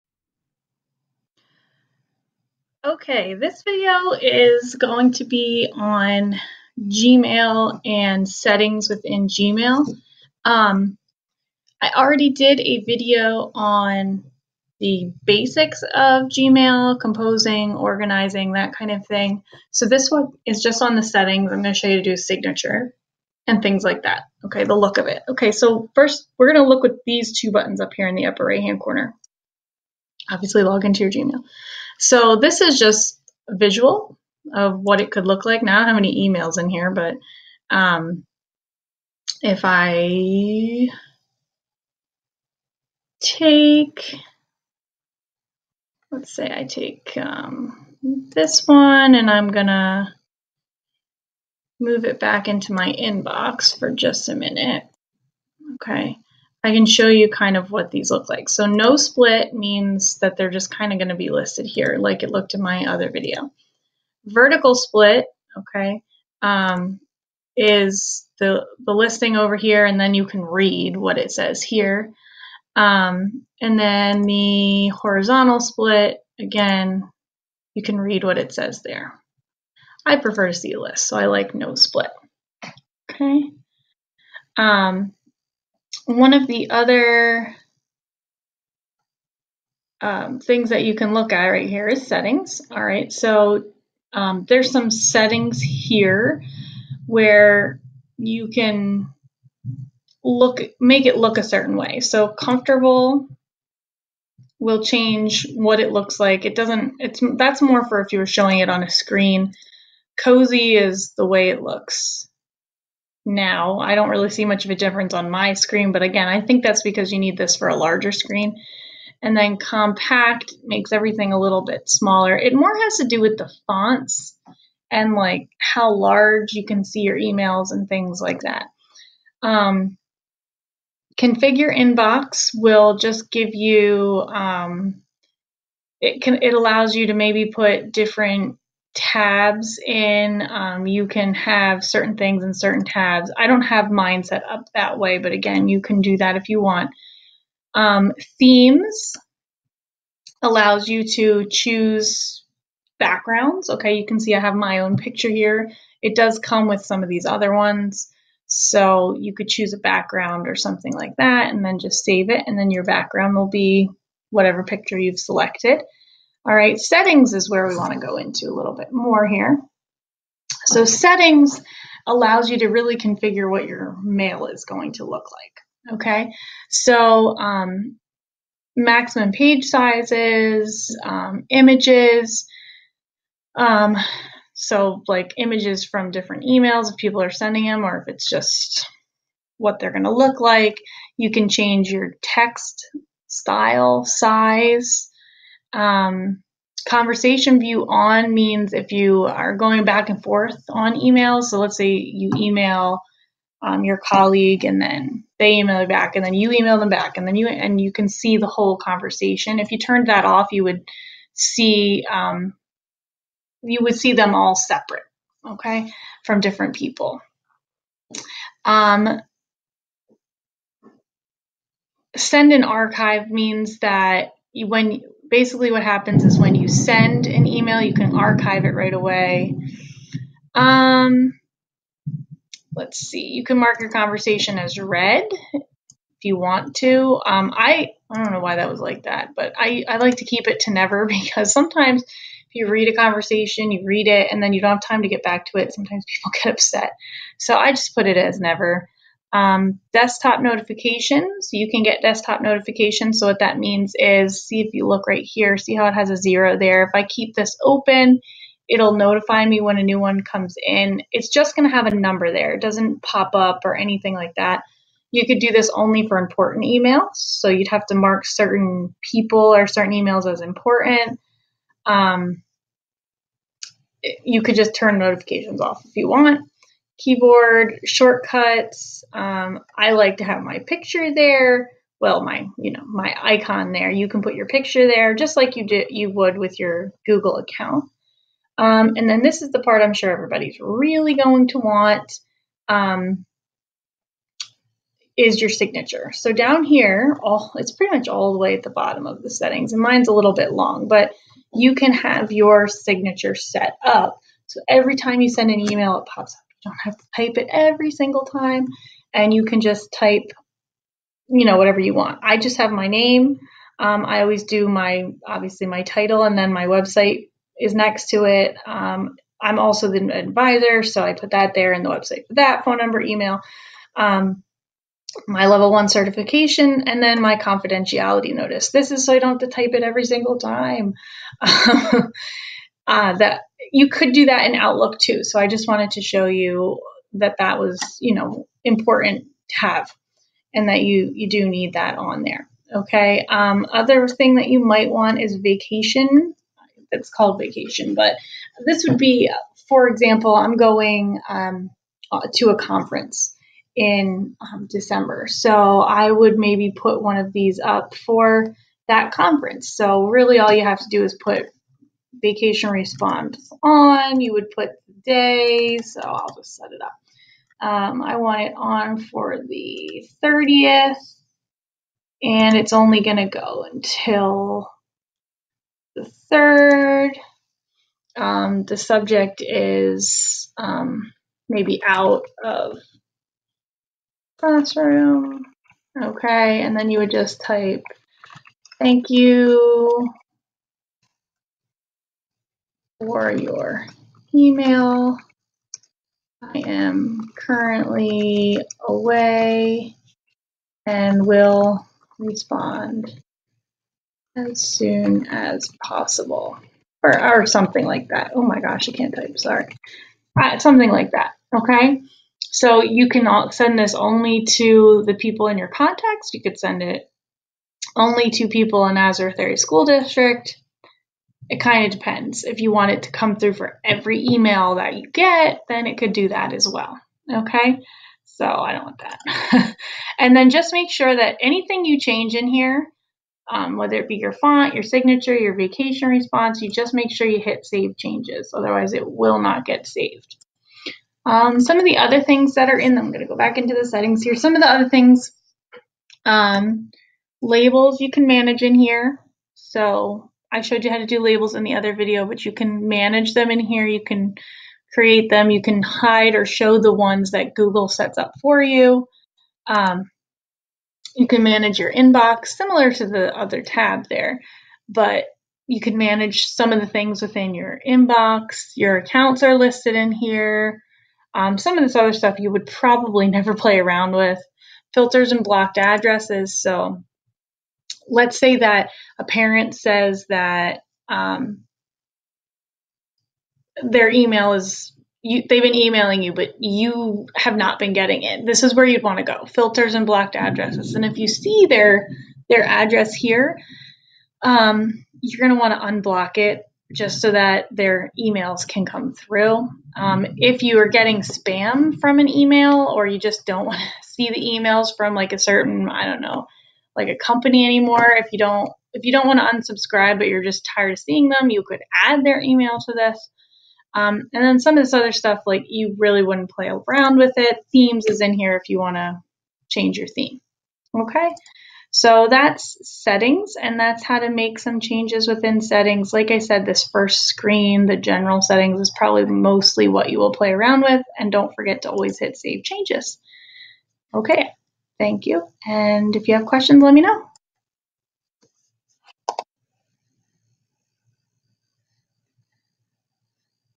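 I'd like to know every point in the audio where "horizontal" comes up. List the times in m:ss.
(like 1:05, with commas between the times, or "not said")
1:14.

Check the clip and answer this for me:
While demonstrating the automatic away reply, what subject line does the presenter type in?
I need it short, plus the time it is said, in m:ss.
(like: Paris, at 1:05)
Out of classroom, at 6:21.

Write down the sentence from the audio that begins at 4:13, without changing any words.
So, what that means is see if you look right here, see how it has a zero there.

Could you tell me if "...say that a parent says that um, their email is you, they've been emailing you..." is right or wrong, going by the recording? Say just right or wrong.
right.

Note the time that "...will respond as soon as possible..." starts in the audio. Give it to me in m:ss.
6:41.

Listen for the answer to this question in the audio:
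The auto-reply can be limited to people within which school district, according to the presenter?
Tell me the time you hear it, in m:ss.
6:58.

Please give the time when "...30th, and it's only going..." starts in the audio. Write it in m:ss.
6:10.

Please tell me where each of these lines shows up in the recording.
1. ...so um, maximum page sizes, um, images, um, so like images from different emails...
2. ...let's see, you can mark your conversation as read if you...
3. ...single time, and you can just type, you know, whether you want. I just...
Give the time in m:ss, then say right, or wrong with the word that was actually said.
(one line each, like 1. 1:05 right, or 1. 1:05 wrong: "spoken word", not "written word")
1. 2:56 right
2. 3:52 right
3. 5:07 wrong: "whatever", not "whether".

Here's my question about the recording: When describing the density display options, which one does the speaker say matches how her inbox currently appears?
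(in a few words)
Cozy.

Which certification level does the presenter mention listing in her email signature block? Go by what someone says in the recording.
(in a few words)
Level one.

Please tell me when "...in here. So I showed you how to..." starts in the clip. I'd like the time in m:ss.
7:28.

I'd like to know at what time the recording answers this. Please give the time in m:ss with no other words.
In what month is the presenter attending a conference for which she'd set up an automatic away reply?
5:54.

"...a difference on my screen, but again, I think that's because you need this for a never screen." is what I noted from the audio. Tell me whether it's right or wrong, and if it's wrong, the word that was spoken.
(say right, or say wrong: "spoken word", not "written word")
wrong: "larger", not "never".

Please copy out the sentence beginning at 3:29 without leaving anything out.
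If you turned that off, you would see um, you would see them all separate, okay, from different people.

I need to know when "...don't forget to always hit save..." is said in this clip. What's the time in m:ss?
8:51.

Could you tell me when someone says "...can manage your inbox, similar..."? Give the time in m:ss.
7:41.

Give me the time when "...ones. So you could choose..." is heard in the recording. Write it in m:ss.
2:37.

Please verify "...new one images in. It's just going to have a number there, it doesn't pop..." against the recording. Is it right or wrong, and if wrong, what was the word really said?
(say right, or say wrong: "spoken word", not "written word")
wrong: "comes", not "images".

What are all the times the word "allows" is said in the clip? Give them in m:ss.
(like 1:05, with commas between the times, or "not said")
2:16, 2:30, 2:52.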